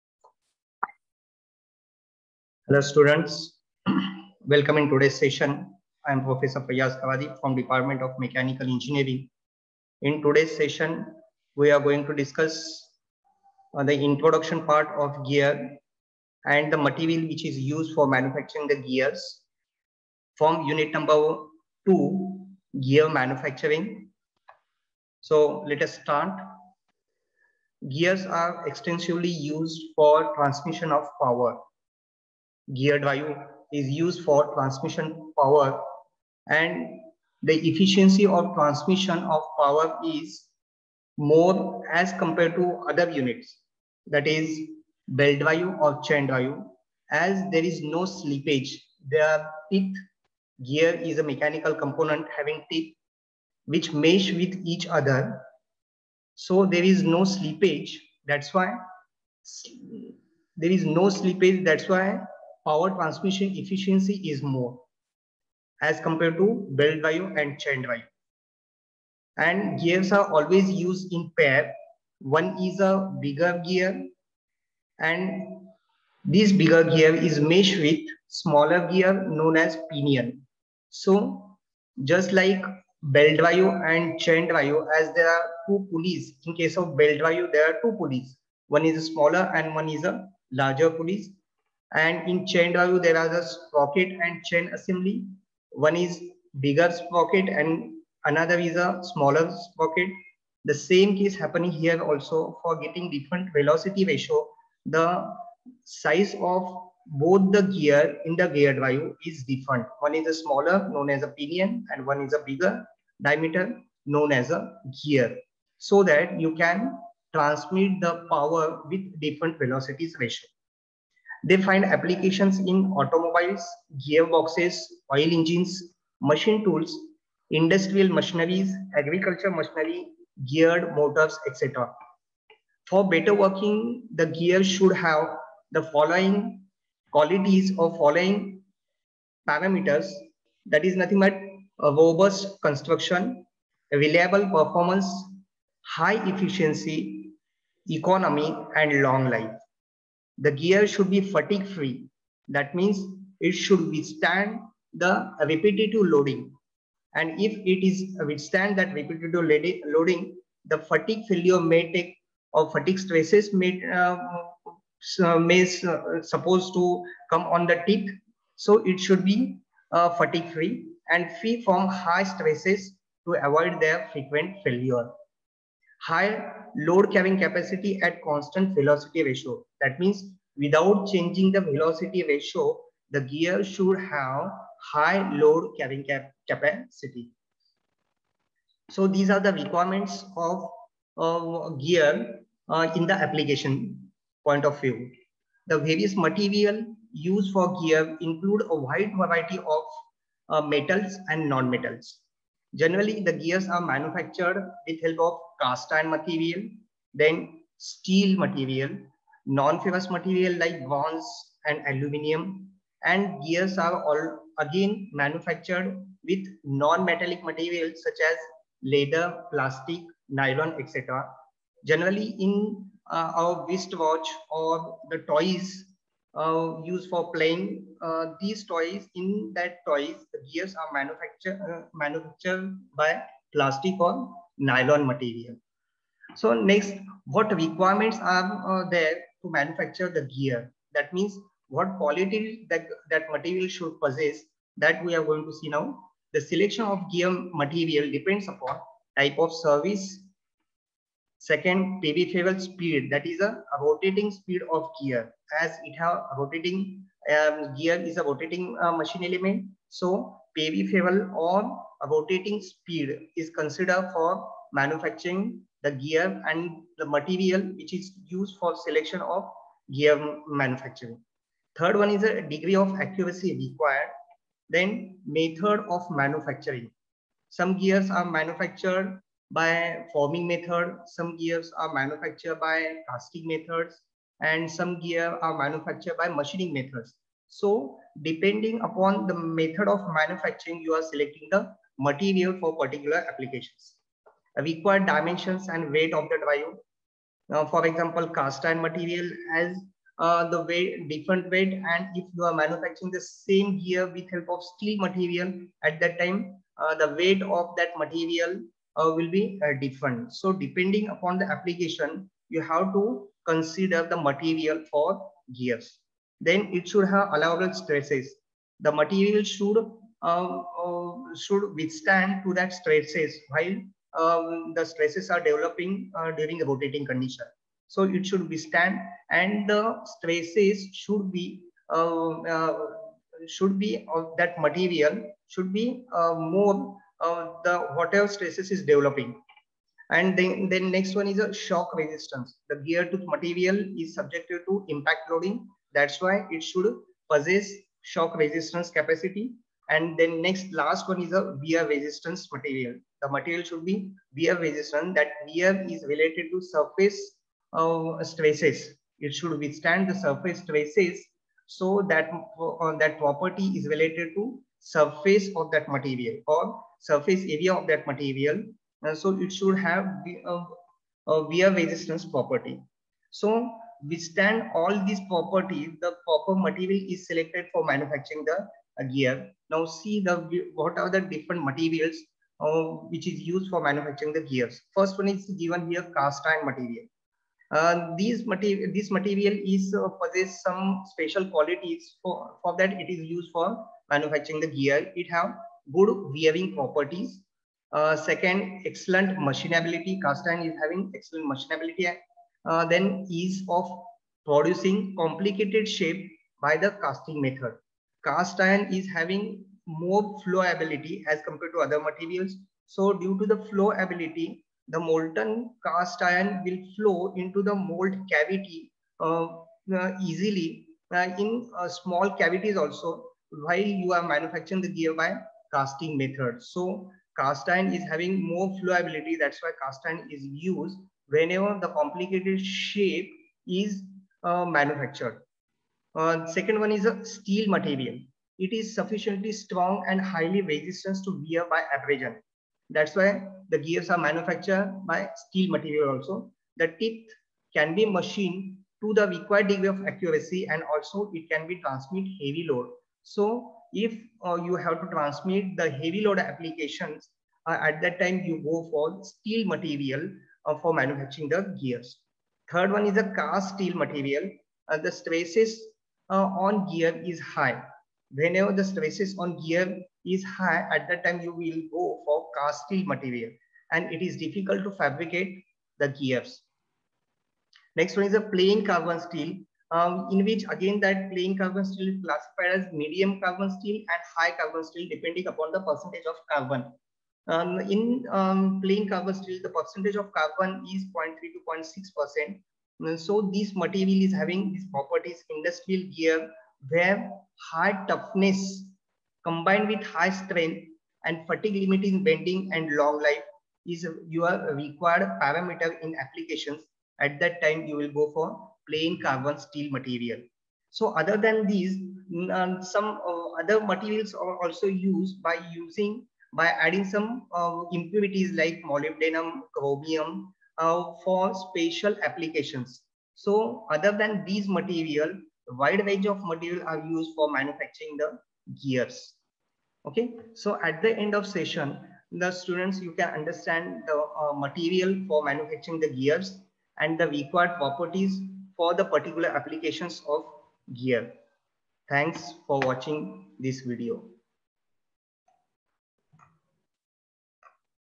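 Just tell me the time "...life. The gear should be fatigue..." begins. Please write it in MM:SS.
02:29.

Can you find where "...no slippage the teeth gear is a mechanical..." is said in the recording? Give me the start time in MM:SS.
00:47.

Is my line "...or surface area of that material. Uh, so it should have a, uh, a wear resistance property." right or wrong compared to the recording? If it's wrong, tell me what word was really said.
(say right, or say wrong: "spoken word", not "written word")
right.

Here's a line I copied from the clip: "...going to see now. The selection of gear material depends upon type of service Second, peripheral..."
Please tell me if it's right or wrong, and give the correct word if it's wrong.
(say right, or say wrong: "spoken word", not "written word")
right.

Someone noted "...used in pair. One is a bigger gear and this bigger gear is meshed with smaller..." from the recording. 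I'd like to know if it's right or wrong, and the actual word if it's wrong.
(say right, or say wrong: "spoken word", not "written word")
right.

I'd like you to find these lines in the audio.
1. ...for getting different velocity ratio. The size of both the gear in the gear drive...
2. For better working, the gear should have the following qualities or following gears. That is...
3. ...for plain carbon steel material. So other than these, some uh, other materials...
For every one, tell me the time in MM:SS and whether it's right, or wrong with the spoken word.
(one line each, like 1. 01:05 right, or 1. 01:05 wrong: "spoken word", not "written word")
1. 01:42 right
2. 02:12 wrong: "parameters", not "gears"
3. 08:28 right.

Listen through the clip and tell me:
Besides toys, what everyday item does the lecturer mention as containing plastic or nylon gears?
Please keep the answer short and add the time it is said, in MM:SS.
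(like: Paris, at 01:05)
Wristwatch, at 03:43.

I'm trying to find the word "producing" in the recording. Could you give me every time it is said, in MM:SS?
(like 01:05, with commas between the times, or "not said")
06:44.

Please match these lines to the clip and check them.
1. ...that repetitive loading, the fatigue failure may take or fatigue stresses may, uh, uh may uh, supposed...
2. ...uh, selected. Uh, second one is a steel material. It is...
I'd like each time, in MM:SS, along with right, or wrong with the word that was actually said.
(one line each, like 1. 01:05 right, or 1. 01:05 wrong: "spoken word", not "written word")
1. 02:38 right
2. 07:14 wrong: "manufactured", not "selected".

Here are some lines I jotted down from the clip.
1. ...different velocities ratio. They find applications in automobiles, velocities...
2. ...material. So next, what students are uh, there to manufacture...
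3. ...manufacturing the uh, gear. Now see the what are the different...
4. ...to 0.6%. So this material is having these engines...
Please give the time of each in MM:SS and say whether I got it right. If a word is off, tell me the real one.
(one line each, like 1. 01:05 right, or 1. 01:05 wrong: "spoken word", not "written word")
1. 01:59 wrong: "gearboxes", not "velocities"
2. 03:55 wrong: "requirements", not "students"
3. 06:17 right
4. 08:11 wrong: "properties", not "engines".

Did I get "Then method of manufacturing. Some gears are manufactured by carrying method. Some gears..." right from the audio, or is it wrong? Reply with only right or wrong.
wrong.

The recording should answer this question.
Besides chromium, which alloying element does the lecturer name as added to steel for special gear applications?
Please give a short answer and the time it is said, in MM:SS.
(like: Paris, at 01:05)
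Molybdenum, at 08:38.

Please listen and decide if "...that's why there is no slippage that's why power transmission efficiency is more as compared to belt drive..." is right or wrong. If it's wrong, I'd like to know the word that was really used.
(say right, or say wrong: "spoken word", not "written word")
right.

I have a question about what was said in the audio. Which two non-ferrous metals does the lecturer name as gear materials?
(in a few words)
Bronze and aluminum.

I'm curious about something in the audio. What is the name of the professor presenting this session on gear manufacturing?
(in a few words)
Fayaz Kawadi.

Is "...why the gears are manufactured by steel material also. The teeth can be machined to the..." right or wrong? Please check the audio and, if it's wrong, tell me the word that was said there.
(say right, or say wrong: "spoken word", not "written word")
right.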